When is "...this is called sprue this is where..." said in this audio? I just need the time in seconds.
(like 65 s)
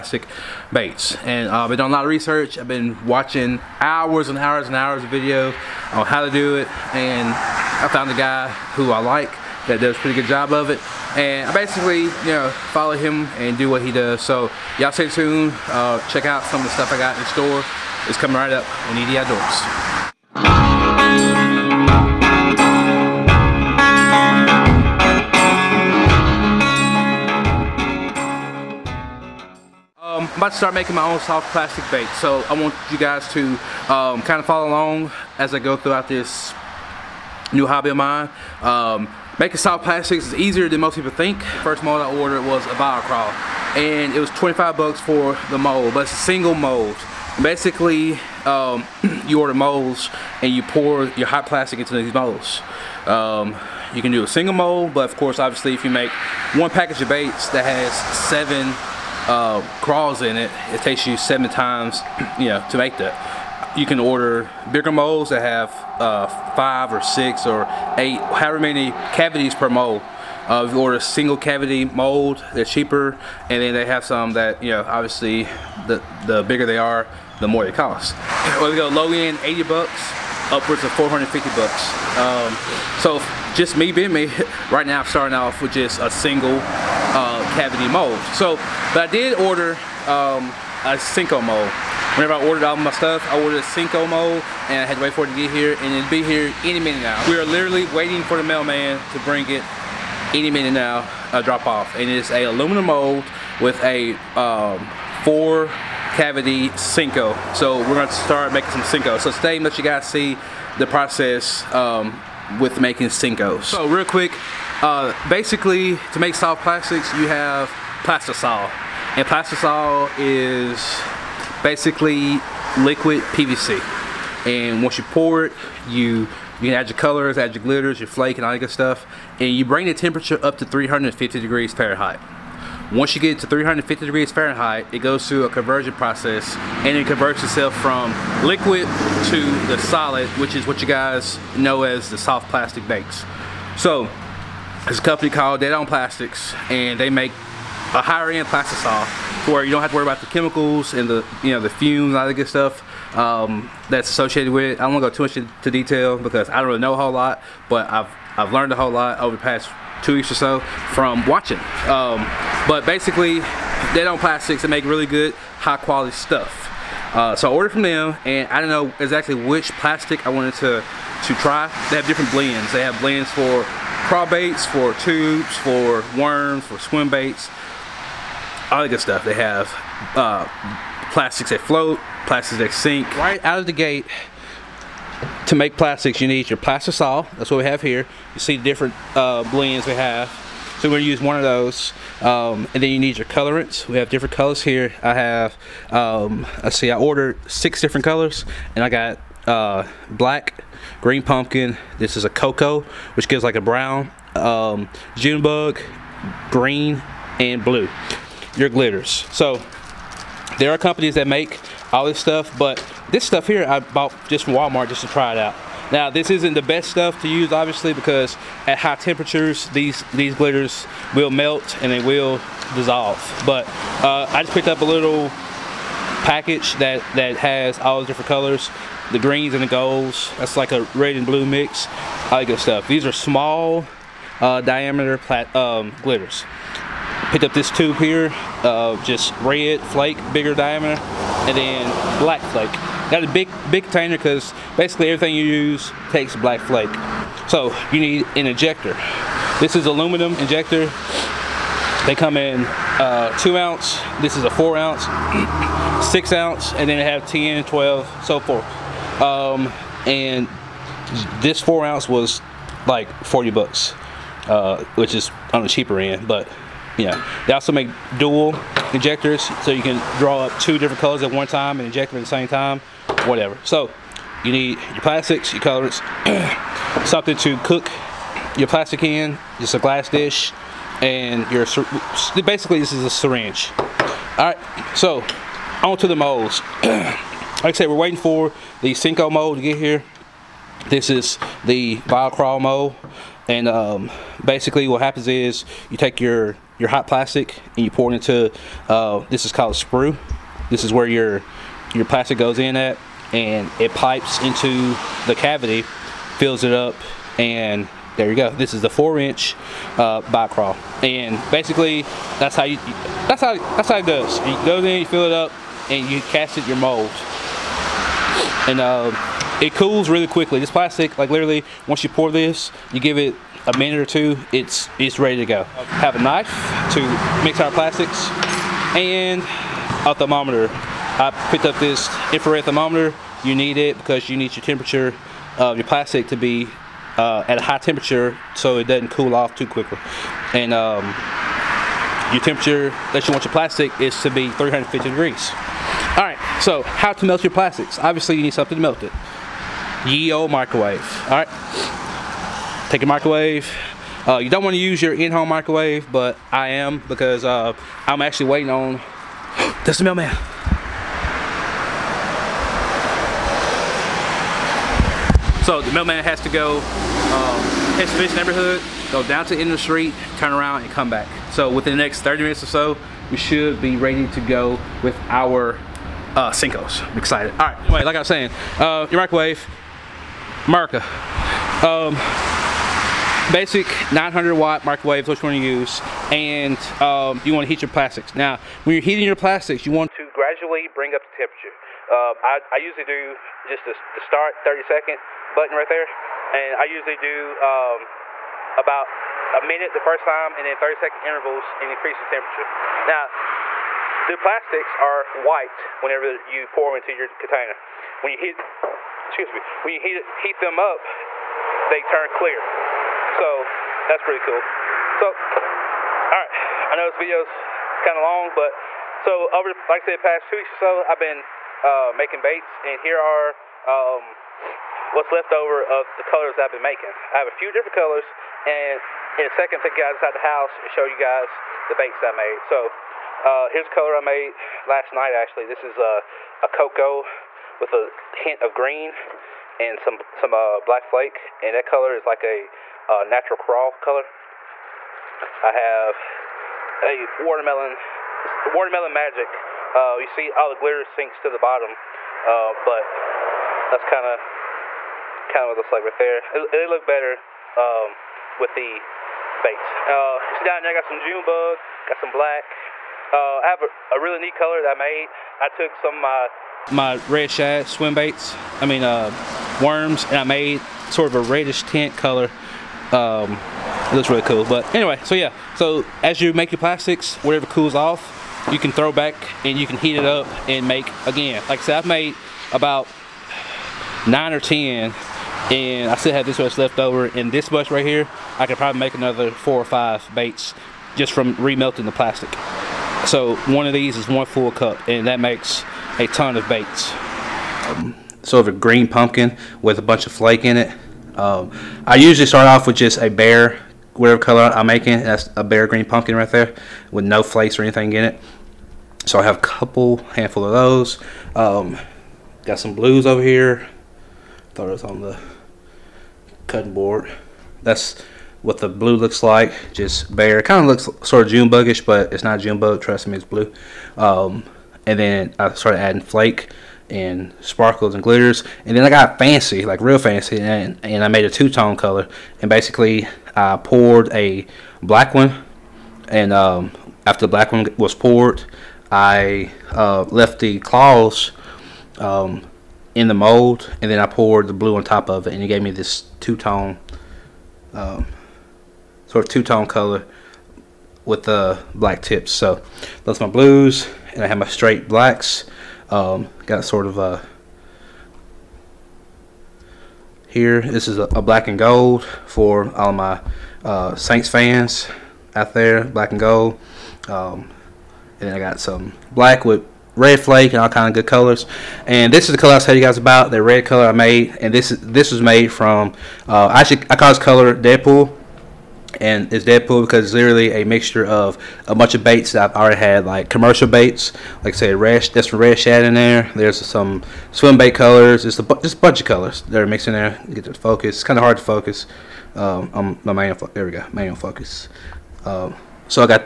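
299 s.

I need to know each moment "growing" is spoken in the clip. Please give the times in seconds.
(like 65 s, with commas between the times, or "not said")
not said.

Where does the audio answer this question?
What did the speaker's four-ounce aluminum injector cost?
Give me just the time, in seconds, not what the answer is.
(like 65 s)
263 s.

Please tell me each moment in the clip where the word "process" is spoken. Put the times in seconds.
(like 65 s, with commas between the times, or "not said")
110 s, 135 s.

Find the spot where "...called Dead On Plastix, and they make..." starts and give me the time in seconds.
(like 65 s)
145 s.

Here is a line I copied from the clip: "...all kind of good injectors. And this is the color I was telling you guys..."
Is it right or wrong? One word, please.
wrong.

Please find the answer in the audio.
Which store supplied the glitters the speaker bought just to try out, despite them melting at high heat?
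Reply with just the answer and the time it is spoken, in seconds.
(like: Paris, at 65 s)
Walmart, at 214 s.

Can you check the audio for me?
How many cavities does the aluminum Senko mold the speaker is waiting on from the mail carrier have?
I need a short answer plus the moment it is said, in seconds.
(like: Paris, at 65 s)
4, at 105 s.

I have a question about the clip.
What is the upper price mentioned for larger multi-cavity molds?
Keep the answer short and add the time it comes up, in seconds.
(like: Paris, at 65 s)
$450, at 80 s.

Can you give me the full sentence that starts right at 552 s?
So that's my blues and I have my straight blacks.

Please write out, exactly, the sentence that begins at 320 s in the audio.
This plastic, like literally, once you pour this, you give it a minute or two, it's, it's ready to go.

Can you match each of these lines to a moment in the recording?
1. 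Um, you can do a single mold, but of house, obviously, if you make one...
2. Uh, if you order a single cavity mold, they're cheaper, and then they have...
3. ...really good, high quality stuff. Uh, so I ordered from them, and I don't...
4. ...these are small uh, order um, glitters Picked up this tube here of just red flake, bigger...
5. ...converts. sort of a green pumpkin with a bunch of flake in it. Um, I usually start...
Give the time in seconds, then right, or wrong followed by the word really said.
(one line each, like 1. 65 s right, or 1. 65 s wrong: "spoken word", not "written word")
1. 53 s wrong: "course", not "house"
2. 70 s right
3. 164 s right
4. 232 s wrong: "diameter", not "order"
5. 496 s wrong: "baits", not "converts".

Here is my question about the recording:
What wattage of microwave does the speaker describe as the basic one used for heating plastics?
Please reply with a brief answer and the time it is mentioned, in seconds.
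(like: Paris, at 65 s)
900 watt, at 384 s.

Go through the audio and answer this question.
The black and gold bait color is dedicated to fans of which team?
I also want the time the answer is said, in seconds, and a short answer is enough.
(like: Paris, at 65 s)
Saints, at 564 s.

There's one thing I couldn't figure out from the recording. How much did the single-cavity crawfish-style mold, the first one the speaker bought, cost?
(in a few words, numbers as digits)
$25.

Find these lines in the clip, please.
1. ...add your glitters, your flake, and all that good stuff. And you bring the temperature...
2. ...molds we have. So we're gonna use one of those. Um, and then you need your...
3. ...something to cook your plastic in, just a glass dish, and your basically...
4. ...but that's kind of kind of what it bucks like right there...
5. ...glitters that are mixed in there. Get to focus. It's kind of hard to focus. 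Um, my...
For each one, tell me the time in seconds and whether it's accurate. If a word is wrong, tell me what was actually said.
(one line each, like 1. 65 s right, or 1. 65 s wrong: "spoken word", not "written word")
1. 127 s right
2. 189 s wrong: "blends", not "molds"
3. 277 s right
4. 452 s wrong: "looks", not "bucks"
5. 589 s wrong: "colors", not "glitters".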